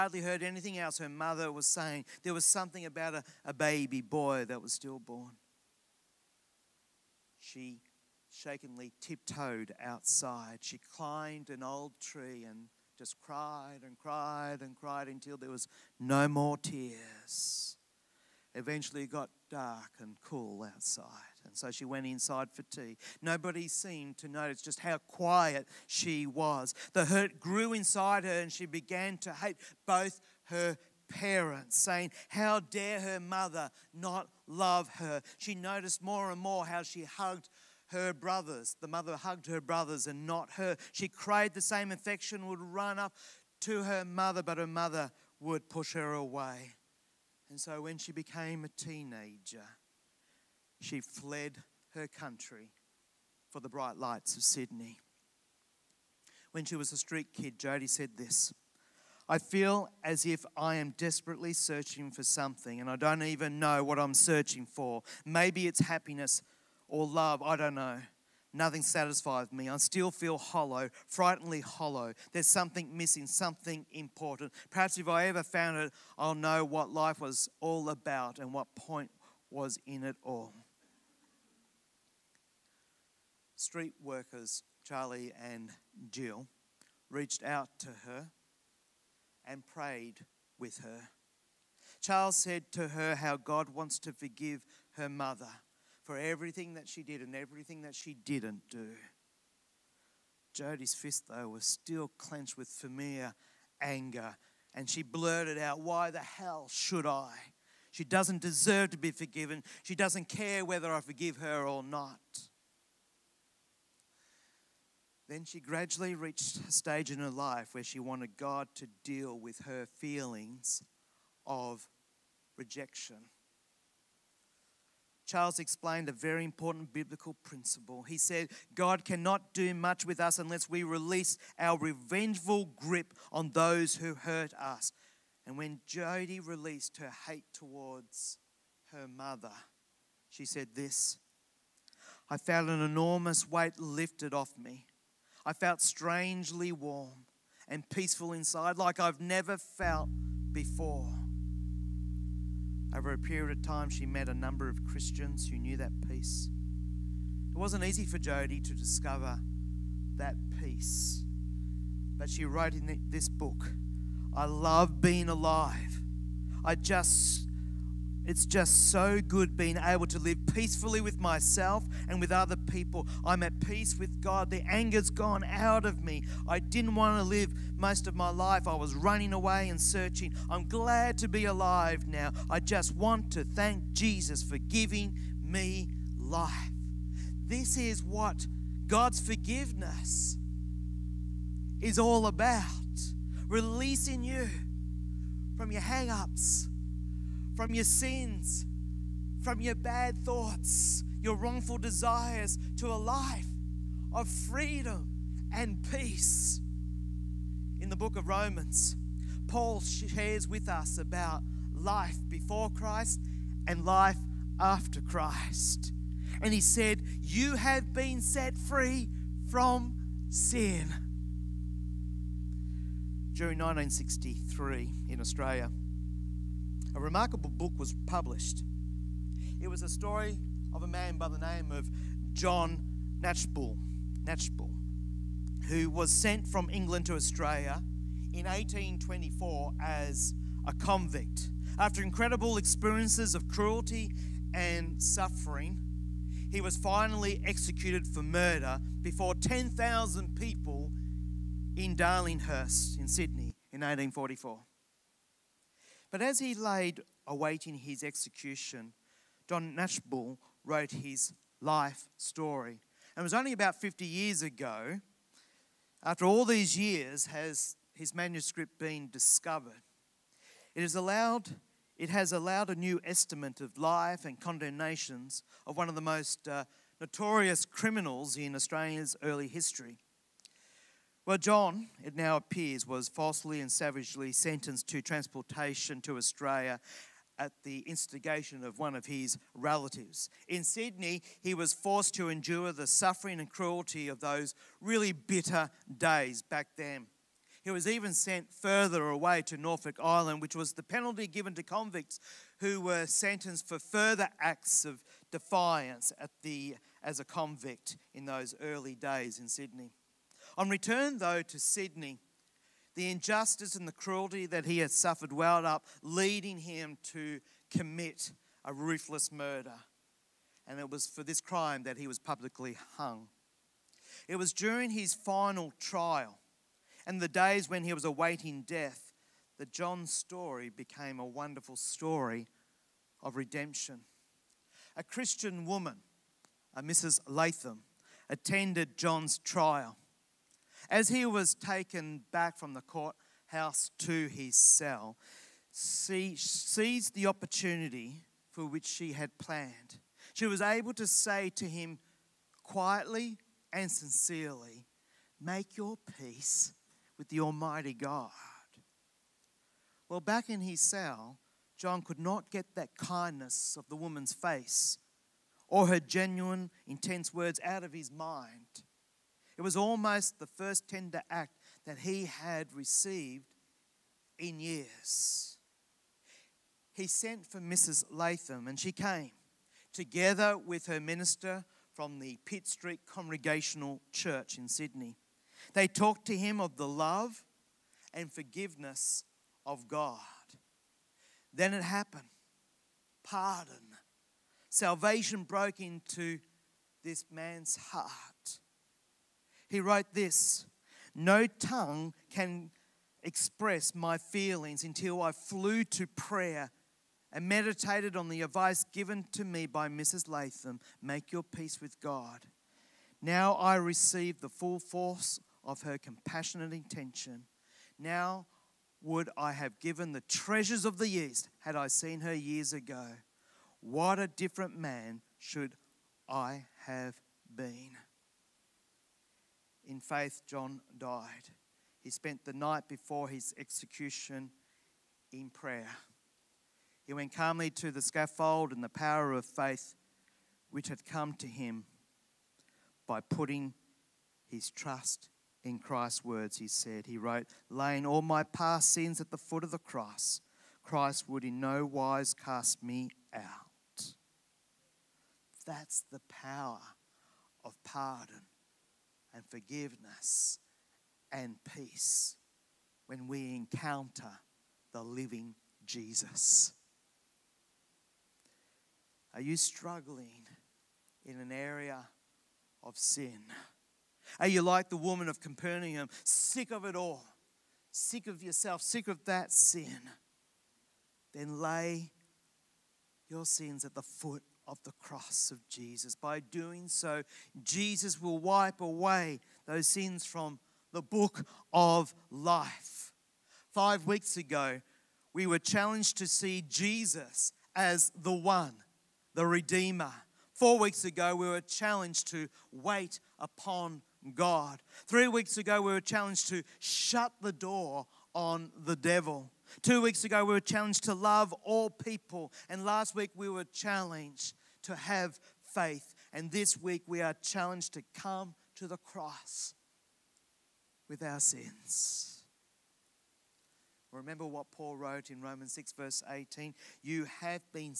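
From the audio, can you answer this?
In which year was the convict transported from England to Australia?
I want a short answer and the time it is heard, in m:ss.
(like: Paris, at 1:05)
1824, at 3:58.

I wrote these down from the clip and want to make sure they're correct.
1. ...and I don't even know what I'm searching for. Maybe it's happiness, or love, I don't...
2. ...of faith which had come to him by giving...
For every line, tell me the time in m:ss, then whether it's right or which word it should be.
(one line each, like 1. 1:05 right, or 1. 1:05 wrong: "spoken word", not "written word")
1. 1:02 right
2. 7:19 wrong: "putting", not "giving".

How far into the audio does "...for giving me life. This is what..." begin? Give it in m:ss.
3:04.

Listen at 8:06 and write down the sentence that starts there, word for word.
By doing so, Jesus will wipe away those sins from the book of life.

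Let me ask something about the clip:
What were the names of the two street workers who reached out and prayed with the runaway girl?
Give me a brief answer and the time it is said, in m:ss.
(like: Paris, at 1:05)
Charlie and Jill, at 1:24.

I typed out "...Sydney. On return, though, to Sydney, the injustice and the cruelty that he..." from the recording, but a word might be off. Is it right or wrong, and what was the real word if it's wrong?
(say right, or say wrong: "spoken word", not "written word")
right.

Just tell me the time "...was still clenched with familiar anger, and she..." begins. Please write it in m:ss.
1:41.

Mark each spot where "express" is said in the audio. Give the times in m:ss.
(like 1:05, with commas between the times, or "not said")
6:43.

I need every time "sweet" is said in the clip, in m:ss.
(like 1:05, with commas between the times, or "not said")
not said.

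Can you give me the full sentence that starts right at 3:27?
In the book of Romans, Paul shares with us about life before Christ and life after Christ.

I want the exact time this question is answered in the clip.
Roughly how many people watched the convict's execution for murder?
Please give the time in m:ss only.
4:09.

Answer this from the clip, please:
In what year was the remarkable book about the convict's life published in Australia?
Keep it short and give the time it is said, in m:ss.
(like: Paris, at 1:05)
1963, at 3:43.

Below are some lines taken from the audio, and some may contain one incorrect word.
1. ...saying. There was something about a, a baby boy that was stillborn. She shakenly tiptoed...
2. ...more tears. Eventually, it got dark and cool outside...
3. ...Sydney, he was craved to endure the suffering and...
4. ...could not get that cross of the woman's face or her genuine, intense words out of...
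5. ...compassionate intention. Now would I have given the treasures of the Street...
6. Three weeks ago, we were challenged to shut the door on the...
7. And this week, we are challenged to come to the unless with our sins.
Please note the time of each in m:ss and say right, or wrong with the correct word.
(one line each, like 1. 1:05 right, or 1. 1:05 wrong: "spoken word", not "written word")
1. 0:01 right
2. 0:16 right
3. 4:50 wrong: "forced", not "craved"
4. 6:02 wrong: "kindness", not "cross"
5. 6:55 wrong: "East", not "Street"
6. 8:25 right
7. 8:36 wrong: "cross", not "unless".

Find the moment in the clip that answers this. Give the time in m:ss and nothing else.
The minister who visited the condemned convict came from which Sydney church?
6:22.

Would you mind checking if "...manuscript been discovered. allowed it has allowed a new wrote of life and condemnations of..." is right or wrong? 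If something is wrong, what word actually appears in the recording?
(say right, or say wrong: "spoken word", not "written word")
wrong: "estimate", not "wrote".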